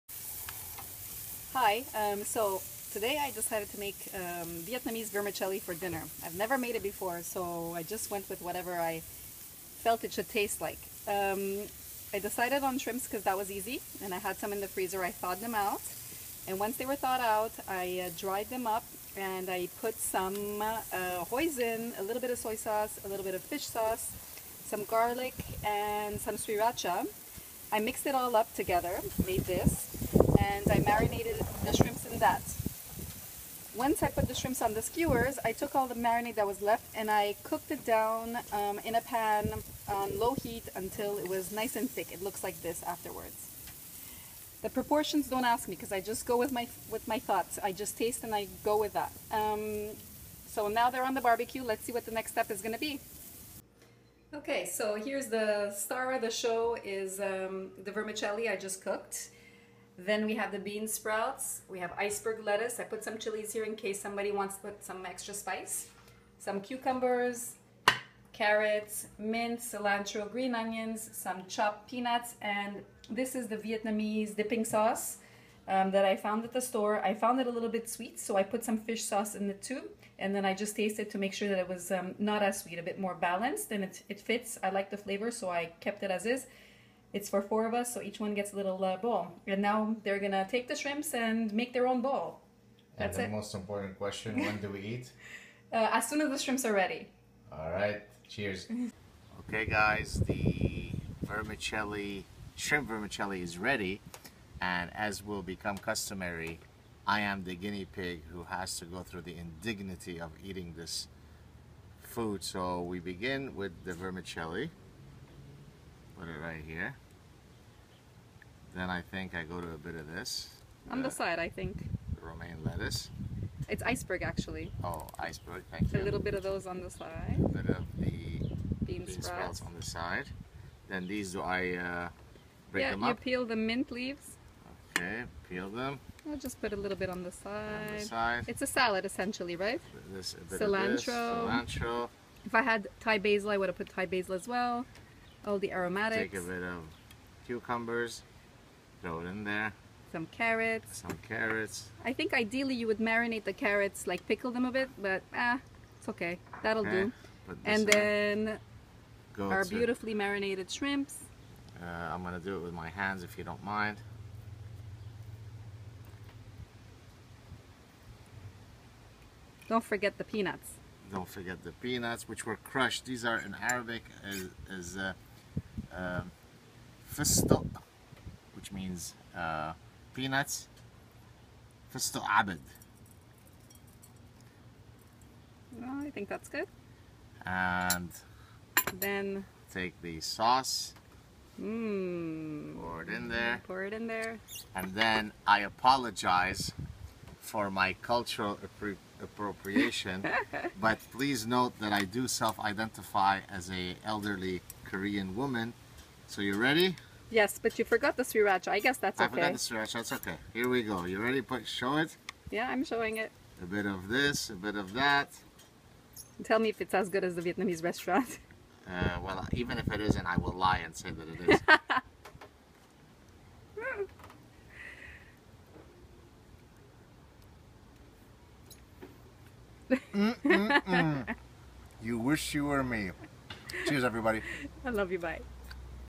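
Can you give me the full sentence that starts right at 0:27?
I mixed it all up together, made this, and I marinated the shrimps in that.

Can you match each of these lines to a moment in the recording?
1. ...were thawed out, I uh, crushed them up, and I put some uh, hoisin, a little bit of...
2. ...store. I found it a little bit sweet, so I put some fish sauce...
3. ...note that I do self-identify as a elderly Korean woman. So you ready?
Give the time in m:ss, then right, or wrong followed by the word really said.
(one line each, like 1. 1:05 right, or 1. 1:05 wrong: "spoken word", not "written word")
1. 0:16 wrong: "dried", not "crushed"
2. 1:16 right
3. 3:21 right.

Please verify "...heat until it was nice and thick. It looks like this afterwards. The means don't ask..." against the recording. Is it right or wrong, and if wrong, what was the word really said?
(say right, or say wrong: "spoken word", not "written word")
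wrong: "proportions", not "means".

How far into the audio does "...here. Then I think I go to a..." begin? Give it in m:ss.
1:56.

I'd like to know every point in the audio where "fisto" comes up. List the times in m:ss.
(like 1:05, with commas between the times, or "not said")
2:57, 3:01.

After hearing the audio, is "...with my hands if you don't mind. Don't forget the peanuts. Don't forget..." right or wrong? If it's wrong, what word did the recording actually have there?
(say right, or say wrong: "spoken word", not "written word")
right.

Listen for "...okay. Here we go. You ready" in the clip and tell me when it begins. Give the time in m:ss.
3:30.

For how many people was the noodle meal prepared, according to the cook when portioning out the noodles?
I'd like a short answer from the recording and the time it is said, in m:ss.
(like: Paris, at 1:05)
4, at 1:27.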